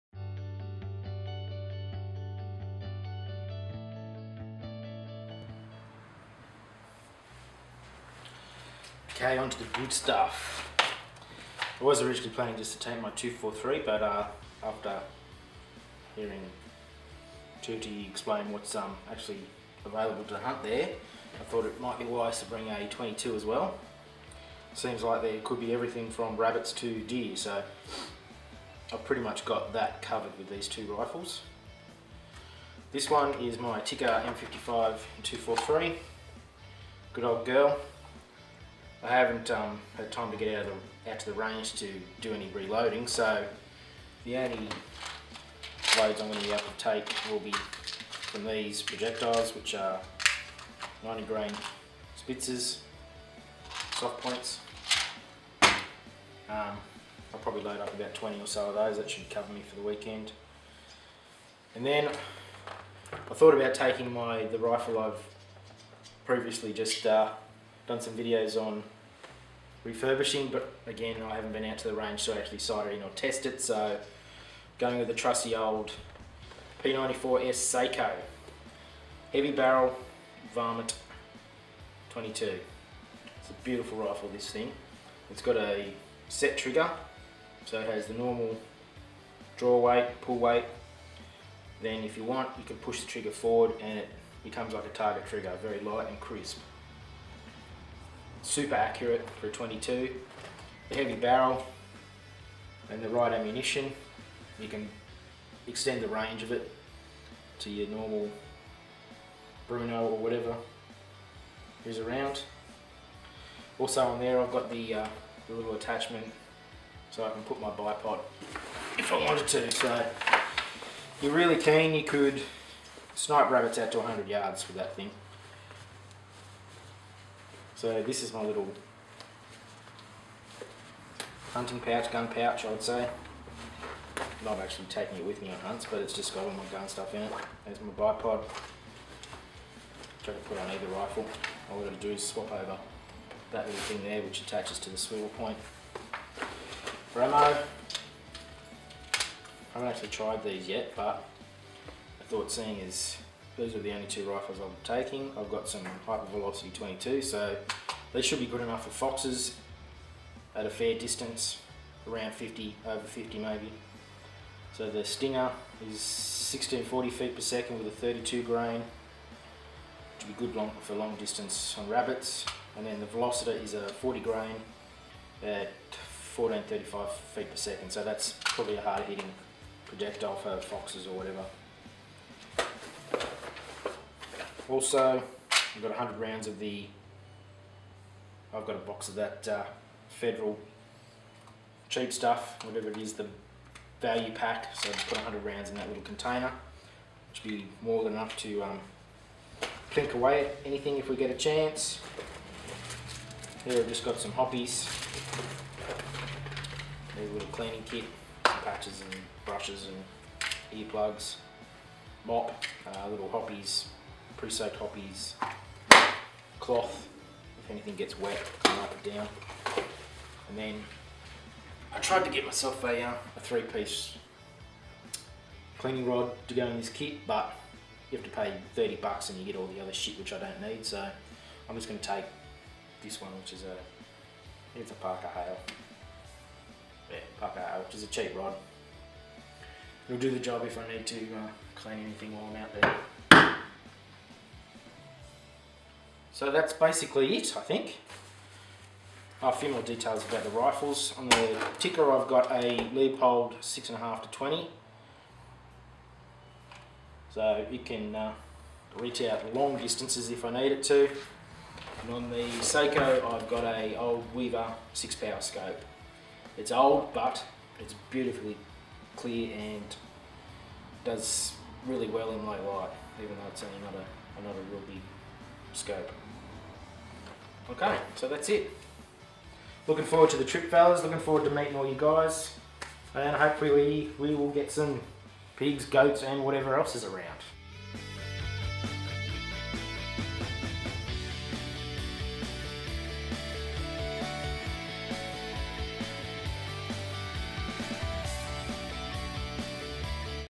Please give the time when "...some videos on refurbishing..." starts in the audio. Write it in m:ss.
1:08.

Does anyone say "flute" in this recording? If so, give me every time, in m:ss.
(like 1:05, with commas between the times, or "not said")
not said.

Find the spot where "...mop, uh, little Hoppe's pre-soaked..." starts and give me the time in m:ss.
3:32.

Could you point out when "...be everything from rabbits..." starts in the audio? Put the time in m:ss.
0:25.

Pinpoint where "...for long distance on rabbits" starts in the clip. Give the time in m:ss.
2:50.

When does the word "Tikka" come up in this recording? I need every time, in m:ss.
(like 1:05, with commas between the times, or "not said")
0:33, 4:11.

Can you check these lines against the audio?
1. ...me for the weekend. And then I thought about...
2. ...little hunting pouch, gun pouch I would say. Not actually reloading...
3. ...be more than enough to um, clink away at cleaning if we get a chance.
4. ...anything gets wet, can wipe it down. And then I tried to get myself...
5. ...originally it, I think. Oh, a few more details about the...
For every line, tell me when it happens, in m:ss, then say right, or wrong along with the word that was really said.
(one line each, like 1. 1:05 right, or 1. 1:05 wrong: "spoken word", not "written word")
1. 0:59 right
2. 2:08 wrong: "taking", not "reloading"
3. 3:17 wrong: "anything", not "cleaning"
4. 3:37 right
5. 4:06 wrong: "basically", not "originally".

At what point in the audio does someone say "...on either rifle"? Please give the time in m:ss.
2:20.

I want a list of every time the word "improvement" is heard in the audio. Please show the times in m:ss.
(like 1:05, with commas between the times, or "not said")
not said.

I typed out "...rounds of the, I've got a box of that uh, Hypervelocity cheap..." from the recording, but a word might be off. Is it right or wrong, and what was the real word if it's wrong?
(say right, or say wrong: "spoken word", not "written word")
wrong: "Federal", not "Hypervelocity".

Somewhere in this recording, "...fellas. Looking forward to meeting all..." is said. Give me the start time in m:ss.
4:40.